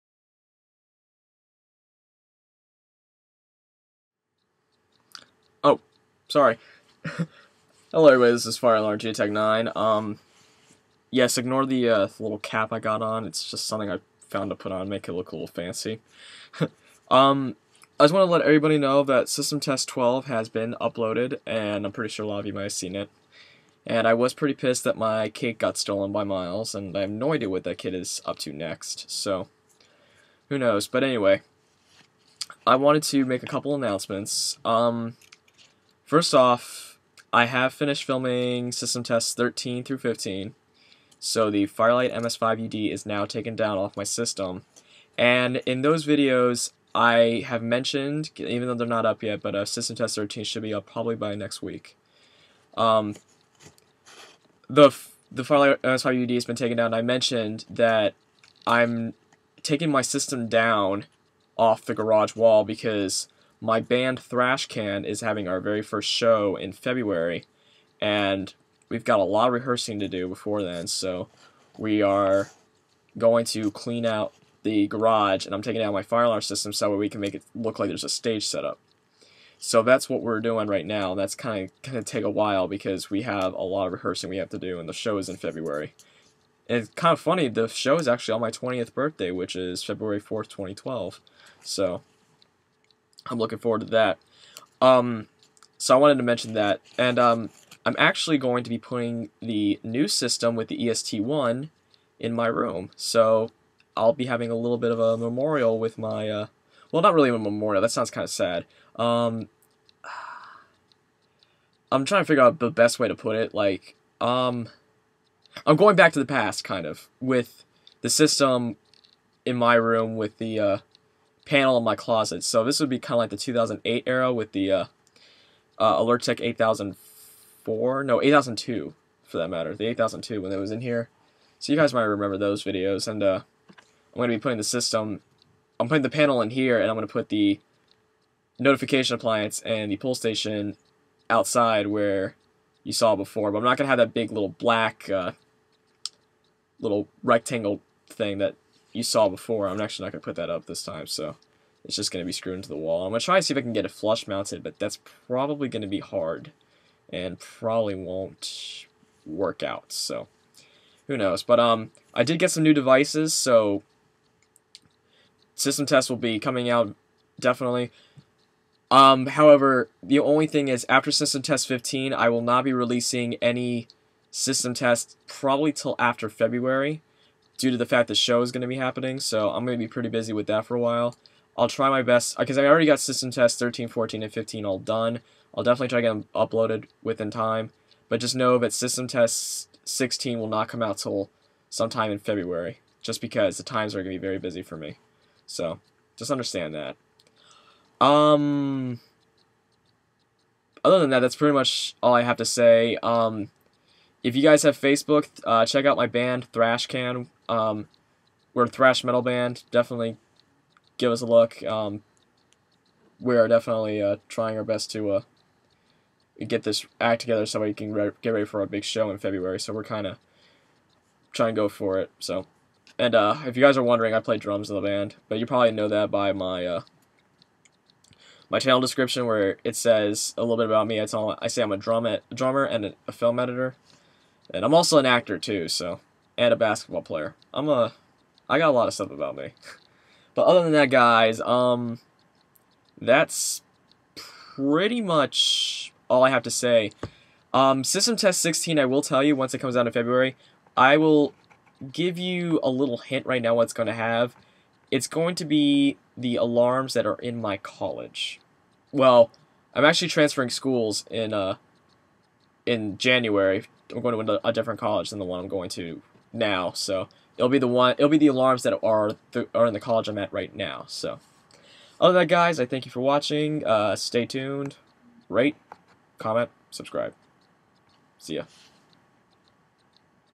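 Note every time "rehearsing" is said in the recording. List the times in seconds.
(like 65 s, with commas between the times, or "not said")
69 s, 83 s.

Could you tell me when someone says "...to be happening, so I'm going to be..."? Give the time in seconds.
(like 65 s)
178 s.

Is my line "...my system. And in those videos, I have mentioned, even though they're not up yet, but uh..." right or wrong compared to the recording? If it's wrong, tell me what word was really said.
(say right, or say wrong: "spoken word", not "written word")
right.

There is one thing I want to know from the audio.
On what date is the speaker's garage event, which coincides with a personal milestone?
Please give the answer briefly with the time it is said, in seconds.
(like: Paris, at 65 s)
February 4th, 2012, at 89 s.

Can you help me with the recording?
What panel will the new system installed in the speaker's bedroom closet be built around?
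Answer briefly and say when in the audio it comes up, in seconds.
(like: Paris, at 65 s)
EST1, at 100 s.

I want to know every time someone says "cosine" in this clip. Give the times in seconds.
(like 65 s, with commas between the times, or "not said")
not said.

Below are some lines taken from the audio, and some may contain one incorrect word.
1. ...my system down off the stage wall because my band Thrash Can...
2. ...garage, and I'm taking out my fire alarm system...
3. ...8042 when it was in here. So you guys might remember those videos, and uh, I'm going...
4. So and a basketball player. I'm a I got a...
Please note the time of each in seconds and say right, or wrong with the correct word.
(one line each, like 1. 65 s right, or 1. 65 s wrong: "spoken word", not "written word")
1. 59 s wrong: "garage", not "stage"
2. 74 s right
3. 129 s wrong: "8002", not "8042"
4. 235 s right.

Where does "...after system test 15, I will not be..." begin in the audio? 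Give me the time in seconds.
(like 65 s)
170 s.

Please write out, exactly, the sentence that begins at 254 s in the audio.
It's going to be the alarms that are in my college.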